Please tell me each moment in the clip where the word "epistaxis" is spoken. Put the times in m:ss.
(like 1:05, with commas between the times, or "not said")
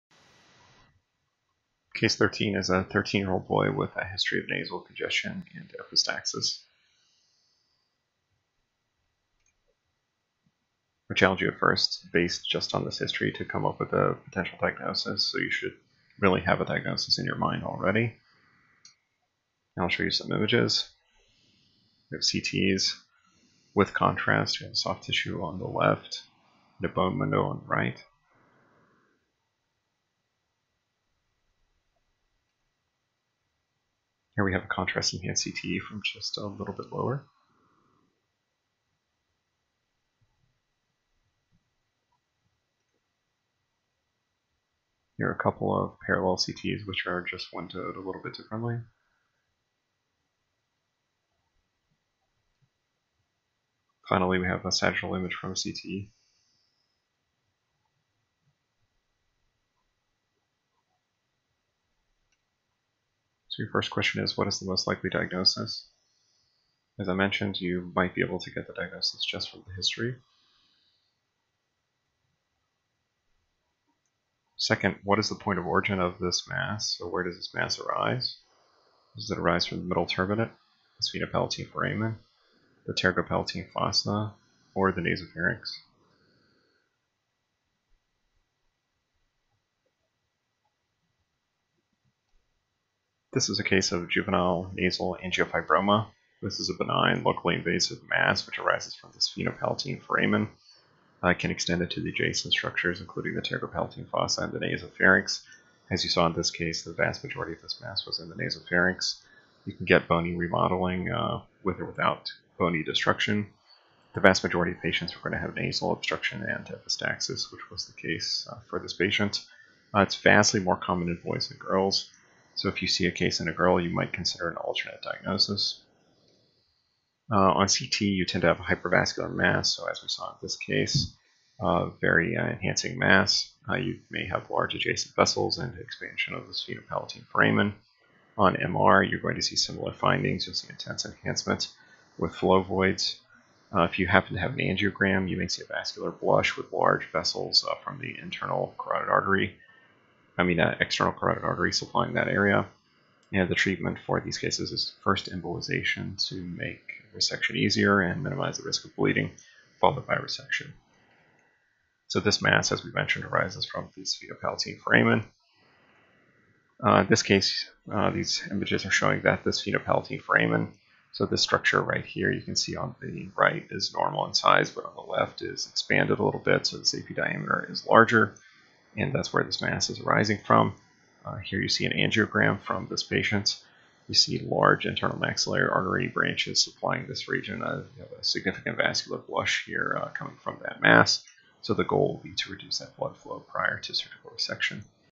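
0:05, 1:56.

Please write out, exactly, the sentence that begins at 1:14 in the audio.
Second, what is the point of origin of this mass?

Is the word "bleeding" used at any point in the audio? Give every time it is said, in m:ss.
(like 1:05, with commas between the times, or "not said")
2:38.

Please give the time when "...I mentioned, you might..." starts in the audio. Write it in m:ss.
1:07.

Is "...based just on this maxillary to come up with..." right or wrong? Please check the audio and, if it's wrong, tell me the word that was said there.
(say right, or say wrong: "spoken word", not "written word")
wrong: "history", not "maxillary".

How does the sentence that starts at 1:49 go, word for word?
You can get bony remodeling uh, with or without bony destruction.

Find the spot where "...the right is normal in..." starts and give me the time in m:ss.
2:53.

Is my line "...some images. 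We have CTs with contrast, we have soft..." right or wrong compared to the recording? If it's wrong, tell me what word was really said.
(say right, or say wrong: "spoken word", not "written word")
right.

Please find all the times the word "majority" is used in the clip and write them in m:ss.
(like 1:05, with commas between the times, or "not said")
1:47, 1:54.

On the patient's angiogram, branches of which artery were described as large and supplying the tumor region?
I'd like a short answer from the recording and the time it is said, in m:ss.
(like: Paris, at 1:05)
internal maxillary artery, at 3:04.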